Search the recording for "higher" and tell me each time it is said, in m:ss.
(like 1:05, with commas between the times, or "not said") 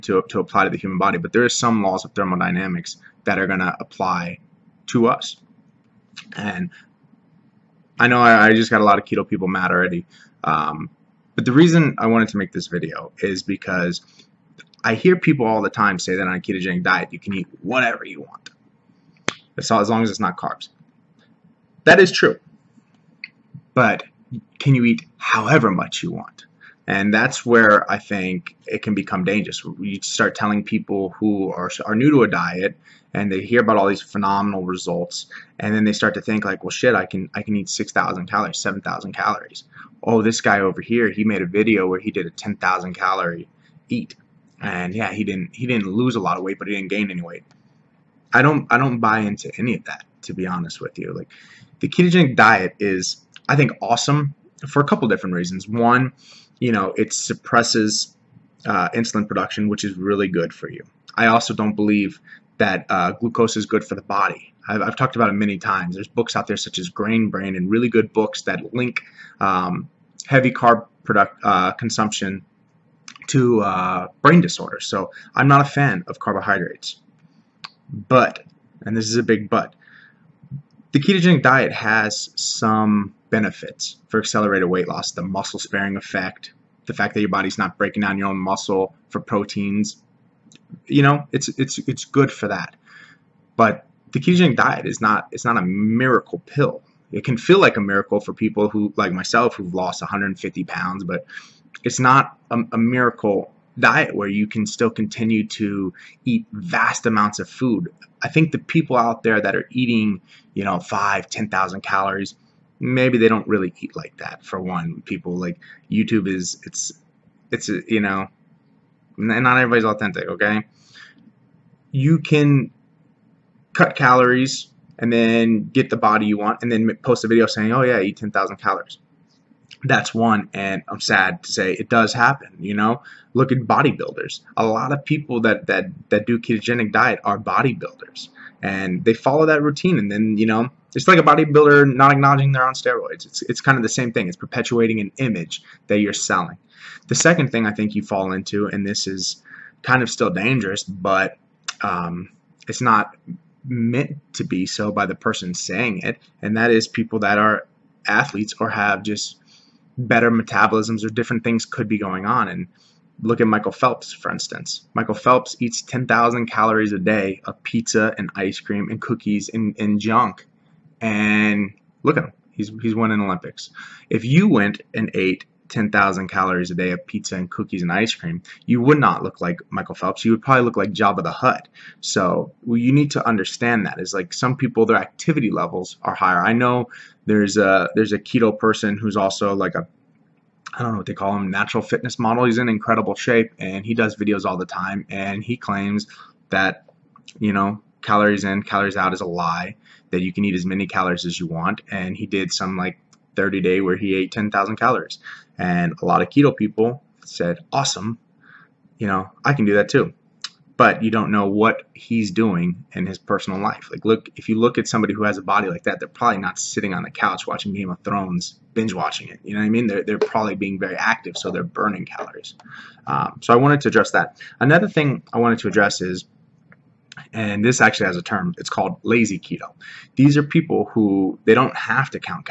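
3:06.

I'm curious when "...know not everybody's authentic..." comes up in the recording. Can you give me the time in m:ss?
1:58.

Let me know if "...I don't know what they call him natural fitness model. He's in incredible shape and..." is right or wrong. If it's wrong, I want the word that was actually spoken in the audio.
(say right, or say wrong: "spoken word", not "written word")
right.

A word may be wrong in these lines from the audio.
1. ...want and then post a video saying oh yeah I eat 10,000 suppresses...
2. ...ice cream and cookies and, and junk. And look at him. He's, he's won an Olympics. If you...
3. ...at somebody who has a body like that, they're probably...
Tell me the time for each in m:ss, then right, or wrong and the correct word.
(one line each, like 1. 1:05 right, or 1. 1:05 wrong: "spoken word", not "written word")
1. 2:06 wrong: "calories", not "suppresses"
2. 2:48 right
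3. 3:34 right.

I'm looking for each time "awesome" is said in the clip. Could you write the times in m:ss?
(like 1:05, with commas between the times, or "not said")
0:53, 3:27.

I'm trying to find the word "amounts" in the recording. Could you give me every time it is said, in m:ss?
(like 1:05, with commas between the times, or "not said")
1:47.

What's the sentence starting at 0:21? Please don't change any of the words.
That is true, but can you eat however much you want?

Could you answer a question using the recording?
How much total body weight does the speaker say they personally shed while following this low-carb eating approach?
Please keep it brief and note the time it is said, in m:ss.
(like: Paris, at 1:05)
150 pounds, at 1:40.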